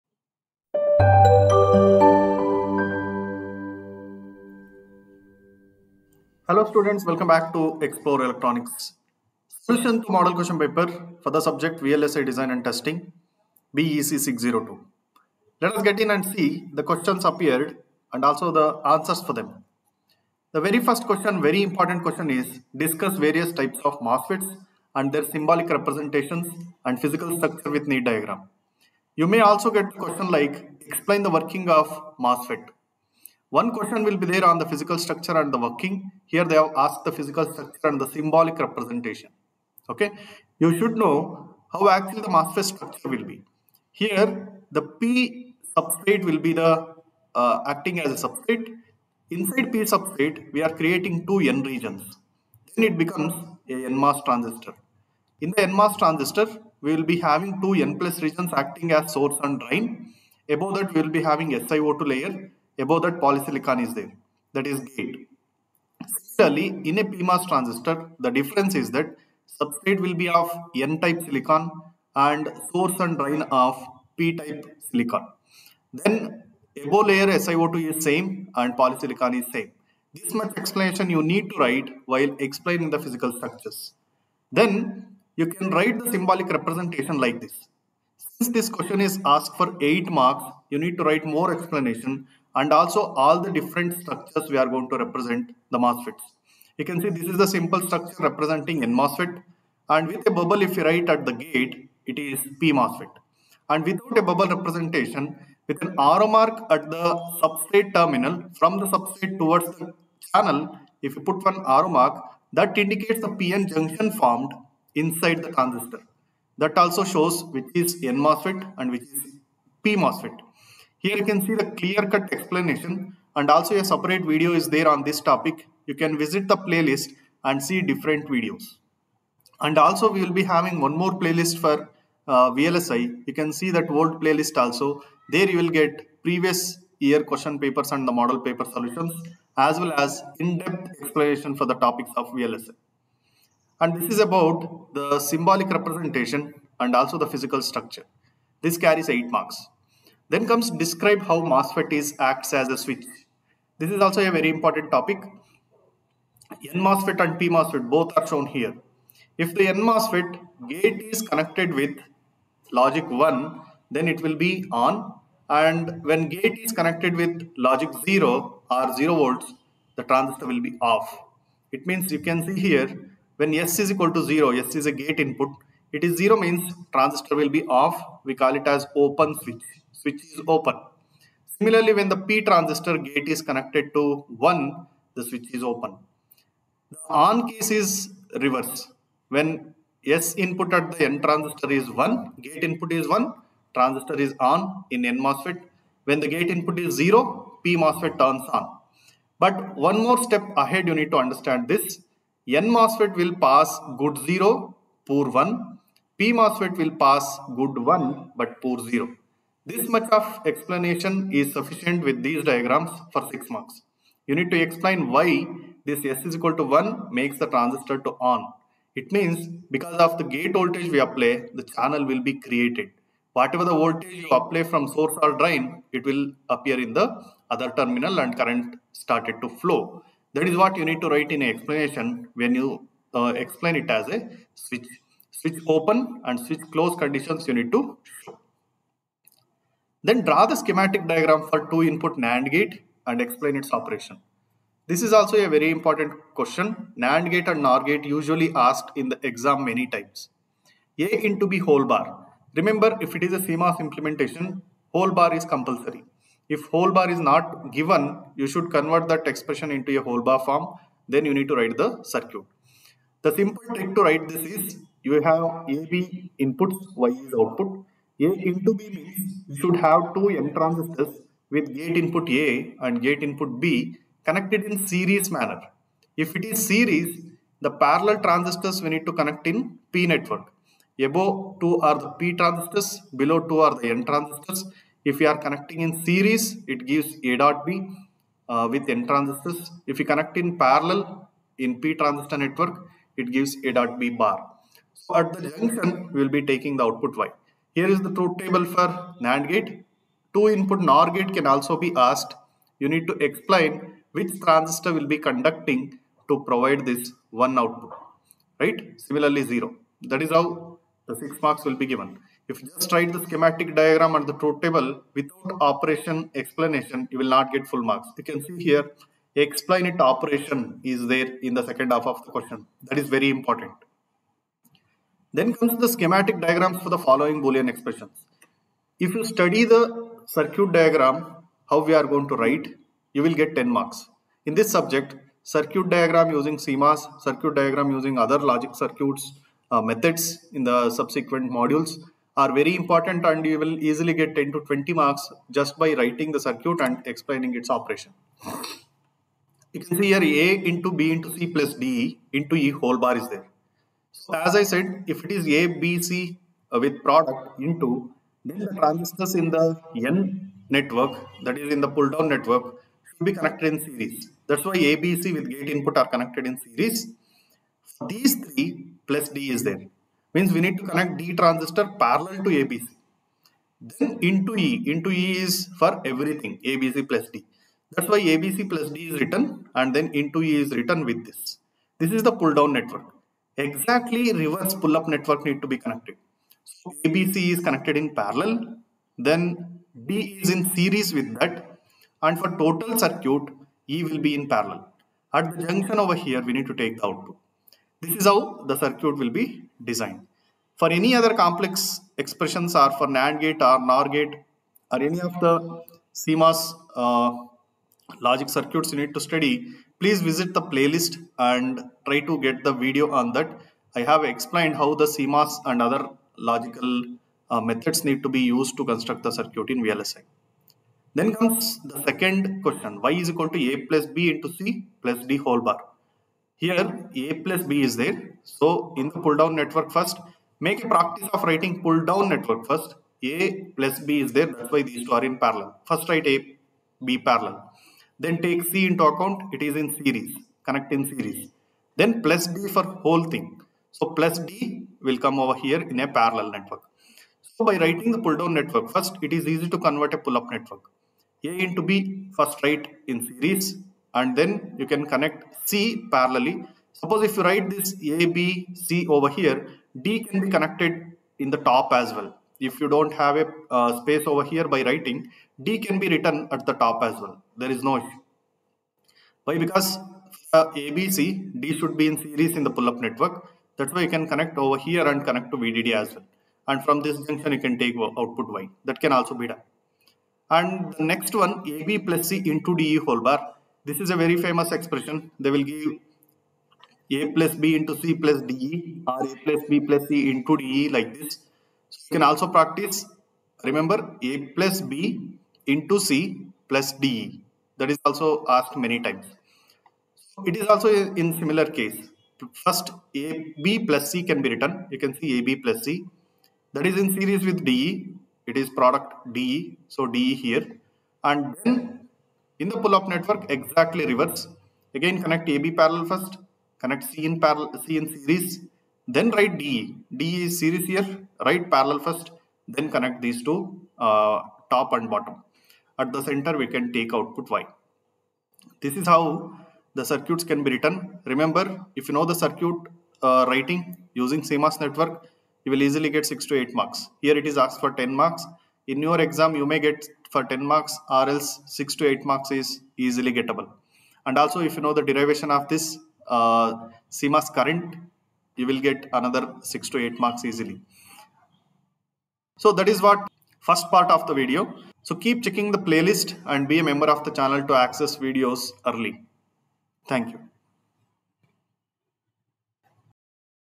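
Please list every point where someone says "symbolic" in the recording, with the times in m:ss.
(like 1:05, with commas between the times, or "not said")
0:25, 0:38, 1:26, 2:25.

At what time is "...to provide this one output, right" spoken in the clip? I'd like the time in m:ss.
5:06.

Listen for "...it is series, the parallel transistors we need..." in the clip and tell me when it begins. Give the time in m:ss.
4:36.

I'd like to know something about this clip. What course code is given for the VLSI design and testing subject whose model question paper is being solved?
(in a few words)
BEC 602.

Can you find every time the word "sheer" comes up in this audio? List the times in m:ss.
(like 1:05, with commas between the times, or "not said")
not said.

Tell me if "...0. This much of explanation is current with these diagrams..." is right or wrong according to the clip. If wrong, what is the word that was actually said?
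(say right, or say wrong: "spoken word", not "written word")
wrong: "sufficient", not "current".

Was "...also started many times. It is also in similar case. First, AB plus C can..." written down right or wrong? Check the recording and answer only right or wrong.
wrong.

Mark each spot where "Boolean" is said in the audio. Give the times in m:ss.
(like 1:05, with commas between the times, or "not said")
5:27.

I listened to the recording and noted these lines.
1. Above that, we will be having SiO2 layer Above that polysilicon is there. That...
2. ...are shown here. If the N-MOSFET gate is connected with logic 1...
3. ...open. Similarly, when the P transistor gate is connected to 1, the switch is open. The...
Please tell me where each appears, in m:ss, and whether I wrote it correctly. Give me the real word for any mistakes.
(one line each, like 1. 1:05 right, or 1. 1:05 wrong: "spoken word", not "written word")
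1. 1:00 right
2. 2:38 right
3. 3:00 right.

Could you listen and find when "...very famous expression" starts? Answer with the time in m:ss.
8:04.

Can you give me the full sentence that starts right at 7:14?
That's why these two are in parallel.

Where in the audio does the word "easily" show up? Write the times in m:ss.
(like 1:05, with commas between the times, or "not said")
5:43, 8:55, 9:03, 9:10.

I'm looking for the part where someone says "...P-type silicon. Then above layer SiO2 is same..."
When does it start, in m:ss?
1:14.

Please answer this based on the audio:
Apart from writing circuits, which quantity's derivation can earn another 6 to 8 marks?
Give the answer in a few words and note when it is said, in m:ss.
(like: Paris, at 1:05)
CMOS current, at 9:07.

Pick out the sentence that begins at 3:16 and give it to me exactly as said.
When the gate input is 0, P MOSFET turns on.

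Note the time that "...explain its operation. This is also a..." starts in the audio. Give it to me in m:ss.
4:03.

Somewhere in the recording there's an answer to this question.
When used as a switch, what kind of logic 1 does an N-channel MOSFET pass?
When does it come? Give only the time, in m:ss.
3:25.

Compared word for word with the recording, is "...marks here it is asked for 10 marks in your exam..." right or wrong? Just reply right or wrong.
right.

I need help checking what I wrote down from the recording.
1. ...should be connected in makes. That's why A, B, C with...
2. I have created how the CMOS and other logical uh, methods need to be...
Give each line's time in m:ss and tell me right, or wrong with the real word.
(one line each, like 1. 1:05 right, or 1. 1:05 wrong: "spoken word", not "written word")
1. 6:03 wrong: "series", not "makes"
2. 6:53 wrong: "explained", not "created".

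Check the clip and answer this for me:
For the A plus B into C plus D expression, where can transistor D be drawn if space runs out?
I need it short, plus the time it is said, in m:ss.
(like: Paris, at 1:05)
At the top, at 7:41.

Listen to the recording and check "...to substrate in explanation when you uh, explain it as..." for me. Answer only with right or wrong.
wrong.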